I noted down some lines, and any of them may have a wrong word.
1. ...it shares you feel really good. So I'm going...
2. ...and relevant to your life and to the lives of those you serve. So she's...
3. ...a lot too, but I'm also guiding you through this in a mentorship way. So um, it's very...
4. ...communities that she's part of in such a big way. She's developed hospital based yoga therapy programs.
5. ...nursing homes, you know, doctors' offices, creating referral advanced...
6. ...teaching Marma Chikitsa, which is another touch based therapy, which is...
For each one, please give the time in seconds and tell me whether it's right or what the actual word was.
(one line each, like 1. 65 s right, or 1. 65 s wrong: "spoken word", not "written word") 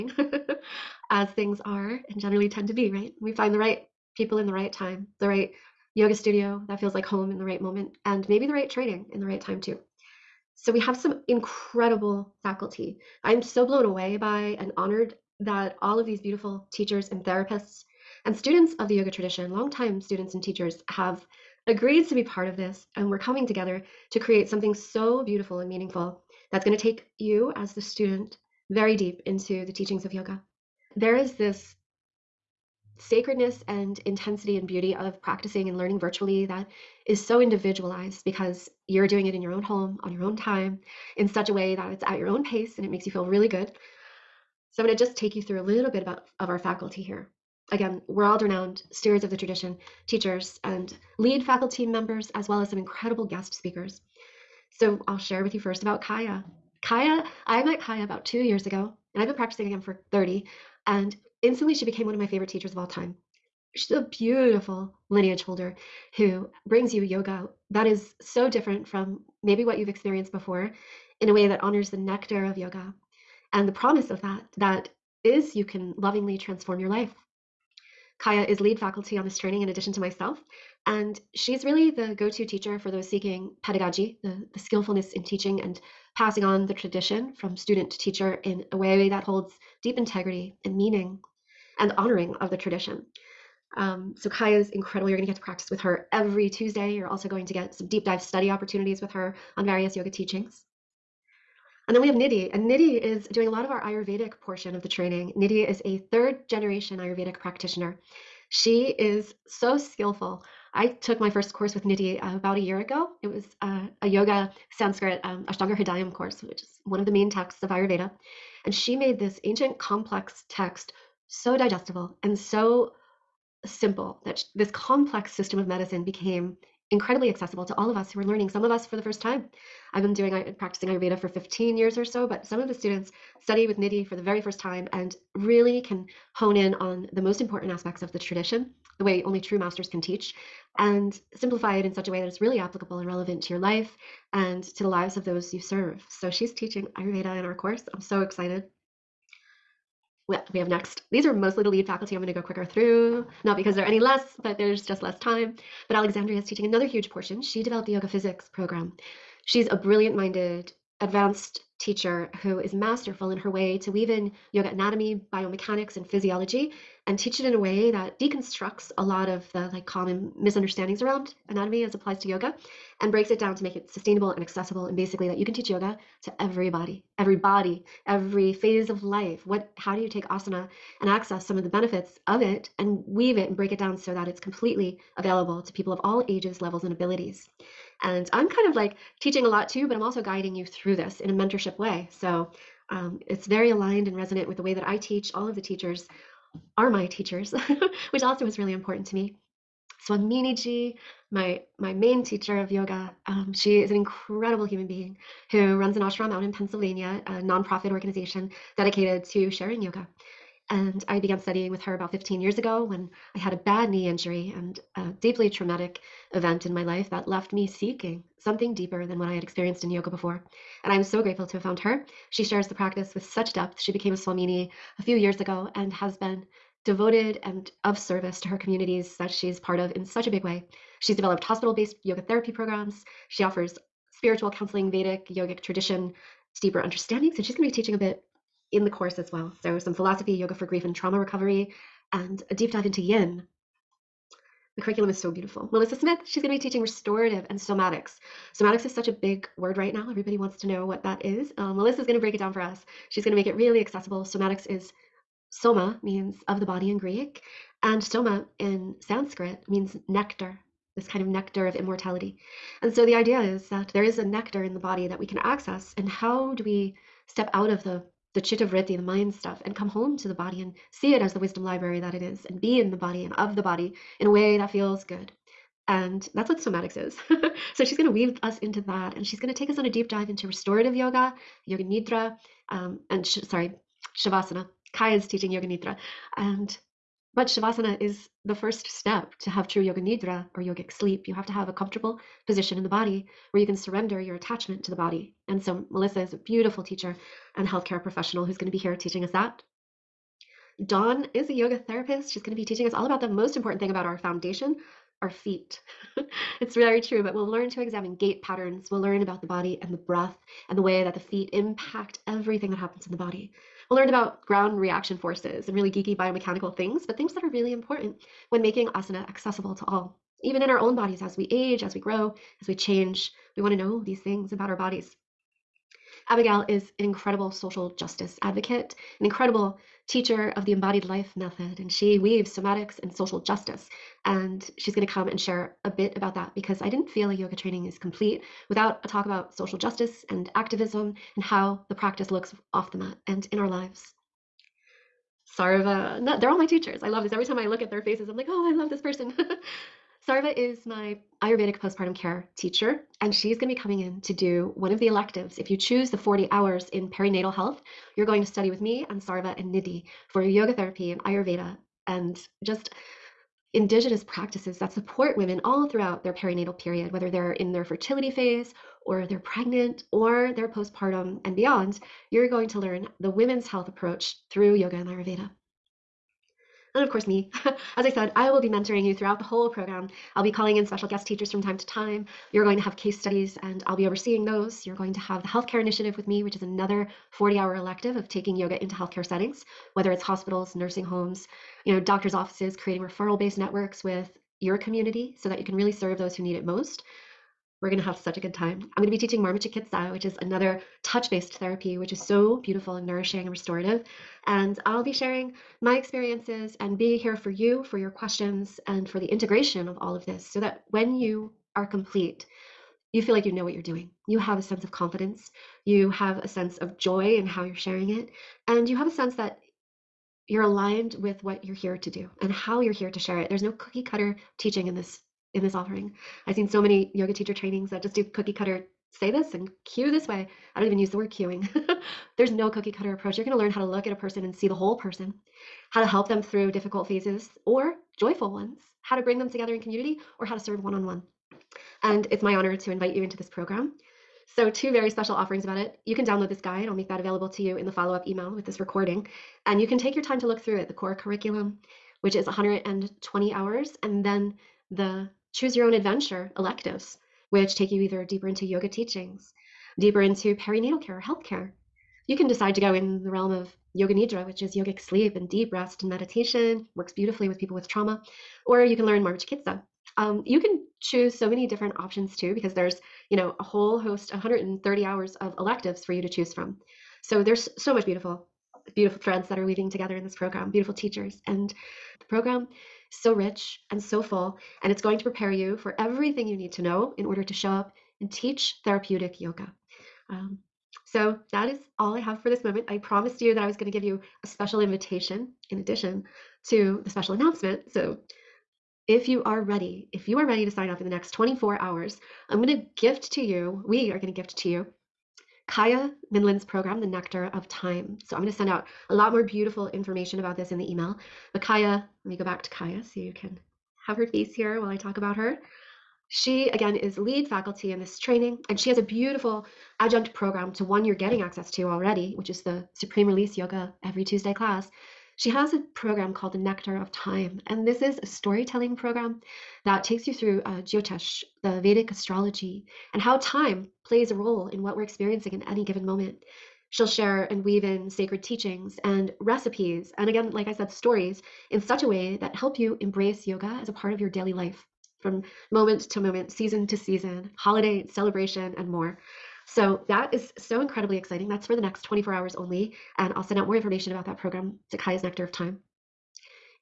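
1. 42 s wrong: "makes", not "shares"
2. 142 s right
3. 189 s right
4. 228 s right
5. 390 s wrong: "based", not "advanced"
6. 399 s right.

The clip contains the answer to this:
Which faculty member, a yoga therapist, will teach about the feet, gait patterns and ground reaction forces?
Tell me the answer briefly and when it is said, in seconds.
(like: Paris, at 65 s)
Dawn, at 300 s.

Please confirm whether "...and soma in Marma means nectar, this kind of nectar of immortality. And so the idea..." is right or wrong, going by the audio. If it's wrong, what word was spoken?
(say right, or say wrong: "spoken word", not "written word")
wrong: "Sanskrit", not "Marma".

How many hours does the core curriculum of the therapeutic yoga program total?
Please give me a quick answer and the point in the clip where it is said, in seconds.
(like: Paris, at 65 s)
120, at 452 s.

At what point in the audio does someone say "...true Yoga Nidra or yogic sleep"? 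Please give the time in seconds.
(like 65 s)
289 s.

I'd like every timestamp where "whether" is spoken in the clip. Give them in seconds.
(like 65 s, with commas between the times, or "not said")
367 s, 389 s.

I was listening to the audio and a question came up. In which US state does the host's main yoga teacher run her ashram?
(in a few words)
Pennsylvania.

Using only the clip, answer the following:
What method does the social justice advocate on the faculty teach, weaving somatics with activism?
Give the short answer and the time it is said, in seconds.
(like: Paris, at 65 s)
embodied life method, at 330 s.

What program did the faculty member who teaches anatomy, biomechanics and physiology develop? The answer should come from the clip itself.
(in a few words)
yoga physics program.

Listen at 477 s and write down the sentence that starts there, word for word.
So there's so much beautiful beautiful threads that are weaving together in this program, beautiful teachers.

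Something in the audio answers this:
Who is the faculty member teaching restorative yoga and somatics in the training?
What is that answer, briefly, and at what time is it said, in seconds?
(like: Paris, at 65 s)
Melissa Smith, at 245 s.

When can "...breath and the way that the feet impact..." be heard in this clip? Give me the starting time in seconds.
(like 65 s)
309 s.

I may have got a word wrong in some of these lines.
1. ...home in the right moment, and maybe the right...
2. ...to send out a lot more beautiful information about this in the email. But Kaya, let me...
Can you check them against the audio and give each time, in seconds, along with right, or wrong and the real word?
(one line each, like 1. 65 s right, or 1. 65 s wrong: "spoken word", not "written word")
1. 7 s right
2. 508 s right.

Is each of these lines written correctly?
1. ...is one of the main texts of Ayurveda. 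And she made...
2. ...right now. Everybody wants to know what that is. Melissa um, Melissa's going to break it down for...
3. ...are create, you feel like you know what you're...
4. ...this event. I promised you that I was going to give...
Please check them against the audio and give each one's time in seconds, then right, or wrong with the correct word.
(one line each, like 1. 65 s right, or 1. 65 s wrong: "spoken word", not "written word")
1. 116 s right
2. 249 s right
3. 411 s wrong: "complete", not "create"
4. 492 s wrong: "moment", not "event".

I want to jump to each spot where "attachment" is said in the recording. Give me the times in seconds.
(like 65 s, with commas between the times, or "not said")
294 s.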